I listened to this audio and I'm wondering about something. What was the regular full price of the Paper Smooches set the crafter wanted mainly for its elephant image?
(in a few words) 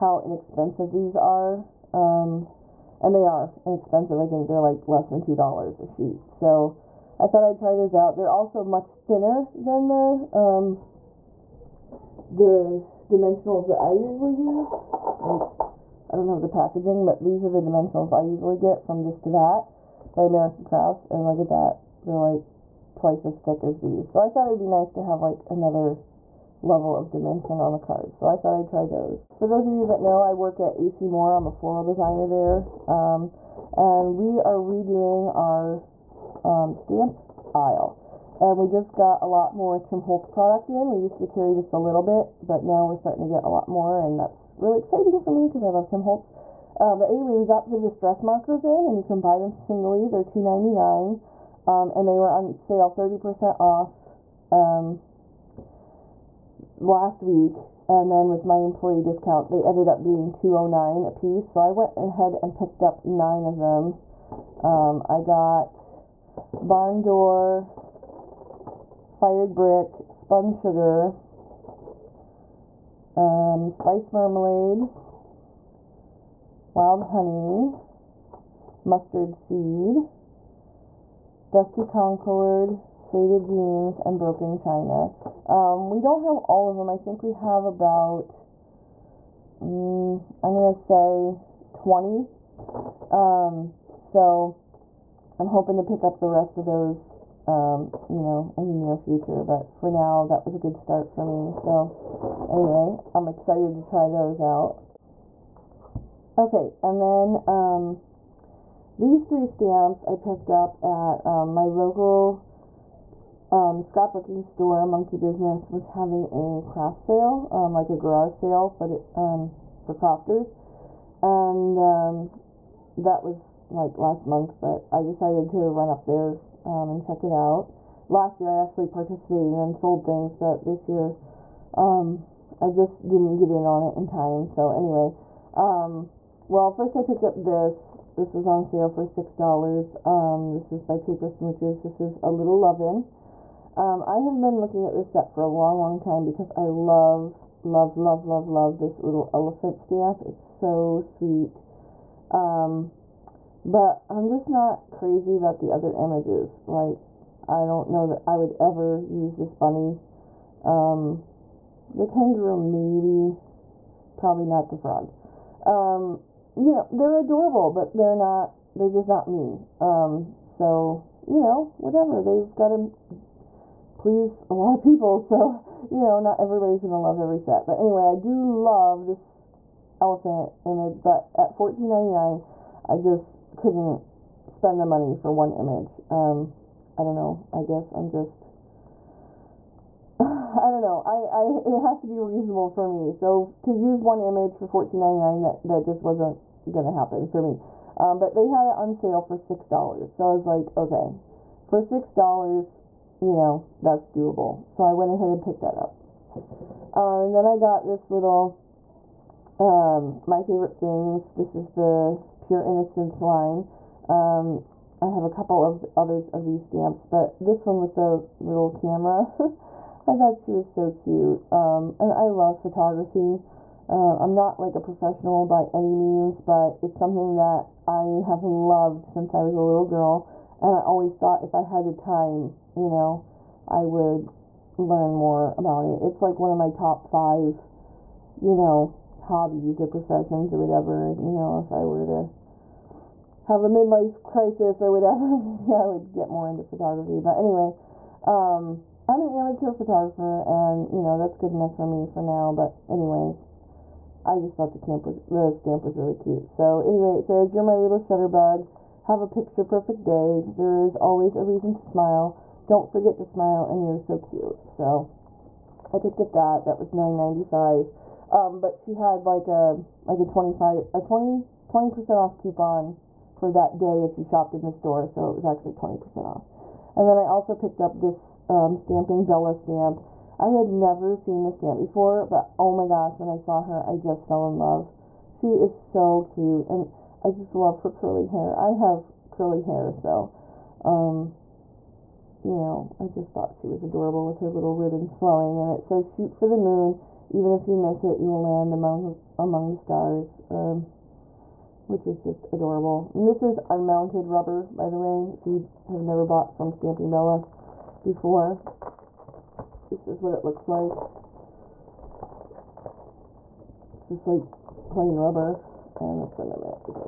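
$14.99.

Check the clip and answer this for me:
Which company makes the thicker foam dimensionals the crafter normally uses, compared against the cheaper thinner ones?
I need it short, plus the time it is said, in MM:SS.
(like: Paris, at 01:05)
American Crafts, at 00:20.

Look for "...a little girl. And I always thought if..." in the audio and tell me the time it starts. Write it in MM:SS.
03:49.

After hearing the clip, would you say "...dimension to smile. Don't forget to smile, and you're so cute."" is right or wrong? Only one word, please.
wrong.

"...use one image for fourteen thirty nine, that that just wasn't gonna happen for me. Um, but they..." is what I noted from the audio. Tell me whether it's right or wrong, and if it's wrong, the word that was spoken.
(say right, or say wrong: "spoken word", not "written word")
wrong: "ninety", not "thirty".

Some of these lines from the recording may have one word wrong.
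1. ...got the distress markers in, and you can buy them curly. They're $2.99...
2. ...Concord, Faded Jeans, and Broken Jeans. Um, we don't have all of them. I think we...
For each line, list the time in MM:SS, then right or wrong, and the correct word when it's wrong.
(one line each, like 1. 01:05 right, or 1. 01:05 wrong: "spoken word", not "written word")
1. 00:47 wrong: "singly", not "curly"
2. 01:21 wrong: "China", not "Jeans".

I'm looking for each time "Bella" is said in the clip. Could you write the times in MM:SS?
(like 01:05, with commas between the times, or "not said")
04:39, 05:07.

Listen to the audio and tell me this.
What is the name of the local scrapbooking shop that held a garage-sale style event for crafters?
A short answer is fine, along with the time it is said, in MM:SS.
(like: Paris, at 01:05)
Monkey Business, at 01:54.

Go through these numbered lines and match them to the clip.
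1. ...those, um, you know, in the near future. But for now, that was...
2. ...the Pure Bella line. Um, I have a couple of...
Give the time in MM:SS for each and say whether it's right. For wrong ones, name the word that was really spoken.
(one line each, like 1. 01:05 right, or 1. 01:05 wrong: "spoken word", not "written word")
1. 01:36 right
2. 03:31 wrong: "Innocence", not "Bella".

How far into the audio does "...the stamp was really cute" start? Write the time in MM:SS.
04:15.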